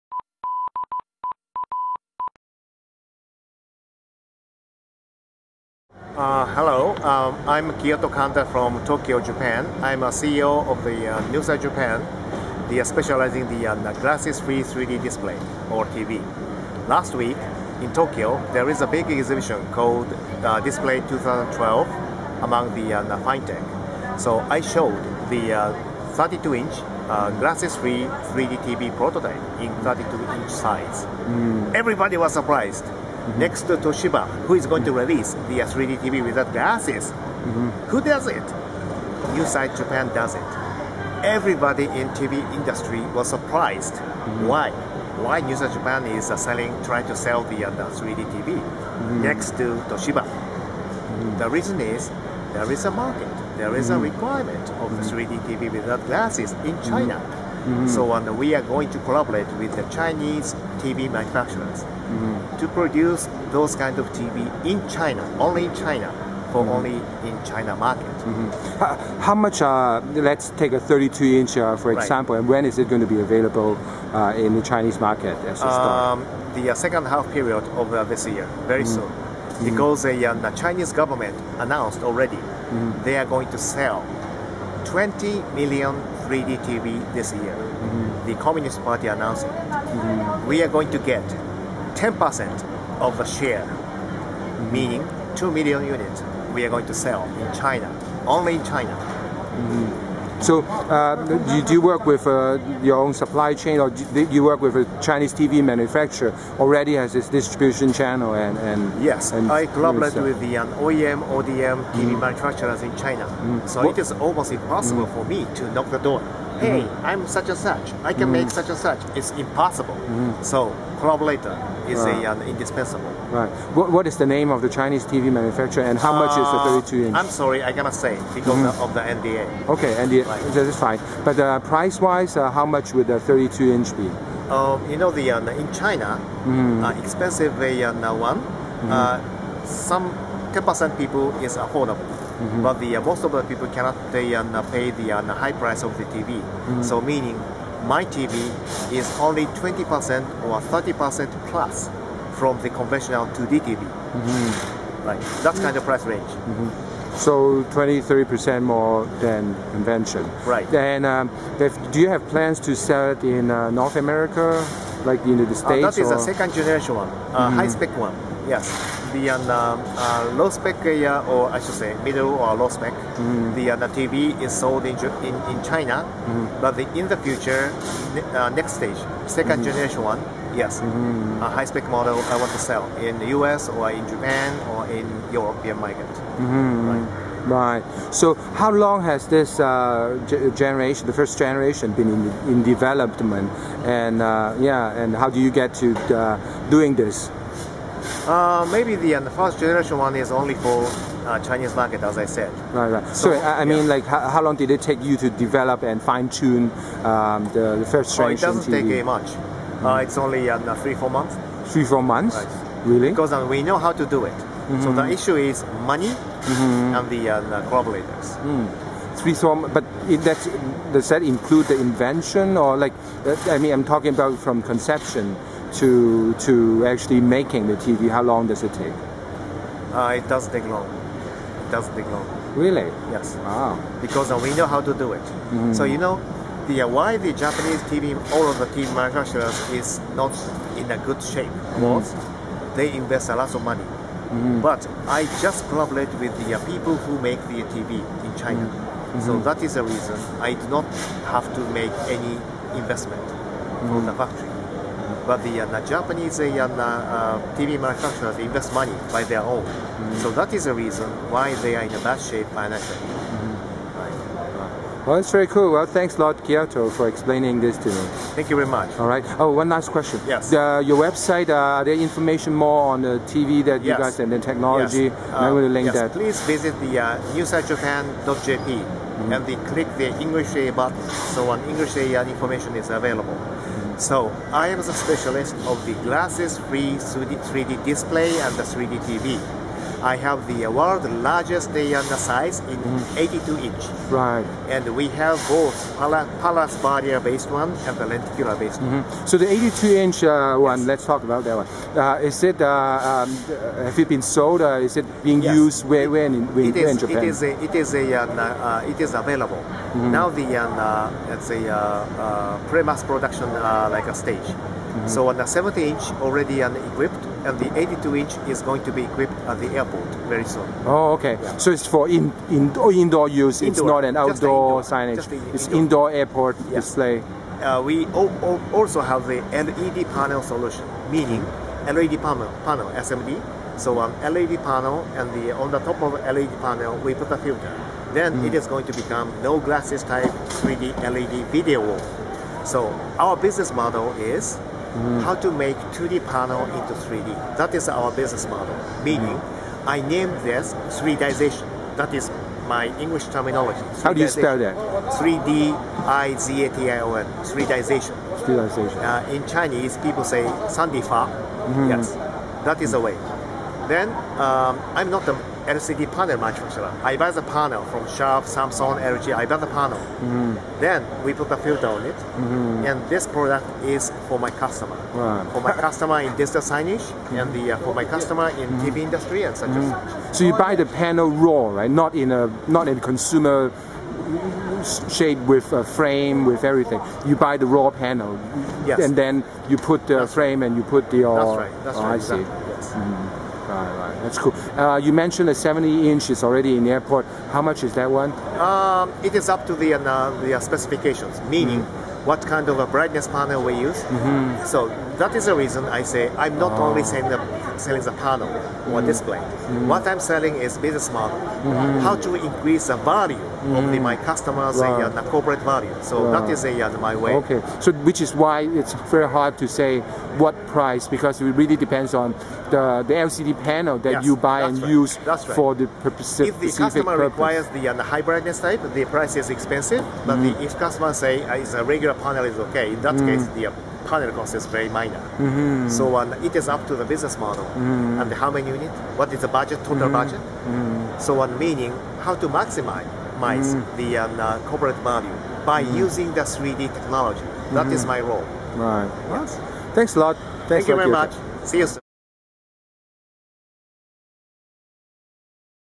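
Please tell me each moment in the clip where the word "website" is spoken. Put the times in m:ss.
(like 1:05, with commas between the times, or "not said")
4:30.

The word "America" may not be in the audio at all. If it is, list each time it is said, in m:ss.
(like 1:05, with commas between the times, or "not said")
2:43.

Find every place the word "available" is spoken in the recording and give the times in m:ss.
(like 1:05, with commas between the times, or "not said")
1:13, 4:42, 5:09.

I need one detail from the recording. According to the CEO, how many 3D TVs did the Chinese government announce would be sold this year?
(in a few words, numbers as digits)
20 million.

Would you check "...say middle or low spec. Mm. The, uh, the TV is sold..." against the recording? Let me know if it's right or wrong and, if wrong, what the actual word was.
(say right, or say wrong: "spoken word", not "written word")
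right.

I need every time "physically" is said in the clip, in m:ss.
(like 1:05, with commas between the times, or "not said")
not said.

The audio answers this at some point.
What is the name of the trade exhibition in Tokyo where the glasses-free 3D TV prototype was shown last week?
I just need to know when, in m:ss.
0:20.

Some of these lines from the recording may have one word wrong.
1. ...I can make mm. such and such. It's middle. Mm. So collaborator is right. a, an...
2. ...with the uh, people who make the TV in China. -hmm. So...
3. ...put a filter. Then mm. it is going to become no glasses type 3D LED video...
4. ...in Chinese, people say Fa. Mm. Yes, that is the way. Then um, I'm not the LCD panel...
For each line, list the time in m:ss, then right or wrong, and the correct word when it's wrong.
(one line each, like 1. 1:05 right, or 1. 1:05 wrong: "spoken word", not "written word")
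1. 1:58 wrong: "impossible", not "middle"
2. 4:06 right
3. 5:37 right
4. 5:59 right.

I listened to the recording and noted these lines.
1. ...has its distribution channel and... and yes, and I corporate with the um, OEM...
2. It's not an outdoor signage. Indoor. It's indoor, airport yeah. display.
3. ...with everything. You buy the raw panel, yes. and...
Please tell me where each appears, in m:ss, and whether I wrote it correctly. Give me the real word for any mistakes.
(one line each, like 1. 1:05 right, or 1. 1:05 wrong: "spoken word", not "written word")
1. 1:46 wrong: "collaborate", not "corporate"
2. 5:23 right
3. 6:26 right.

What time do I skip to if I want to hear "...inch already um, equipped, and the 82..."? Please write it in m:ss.
5:15.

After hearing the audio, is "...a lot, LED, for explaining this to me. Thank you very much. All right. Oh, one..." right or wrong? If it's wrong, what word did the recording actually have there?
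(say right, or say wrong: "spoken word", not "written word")
wrong: "Kiyoto", not "LED".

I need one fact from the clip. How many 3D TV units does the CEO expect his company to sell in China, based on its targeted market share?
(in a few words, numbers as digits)
2 million.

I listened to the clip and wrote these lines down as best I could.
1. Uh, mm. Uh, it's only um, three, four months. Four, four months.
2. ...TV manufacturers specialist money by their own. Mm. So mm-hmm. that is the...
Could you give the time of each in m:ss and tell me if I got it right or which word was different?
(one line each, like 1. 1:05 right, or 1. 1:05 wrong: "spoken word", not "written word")
1. 3:29 wrong: "Three", not "Four"
2. 4:17 wrong: "invest", not "specialist".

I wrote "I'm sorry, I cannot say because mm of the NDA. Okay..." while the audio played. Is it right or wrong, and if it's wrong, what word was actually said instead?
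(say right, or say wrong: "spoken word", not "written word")
right.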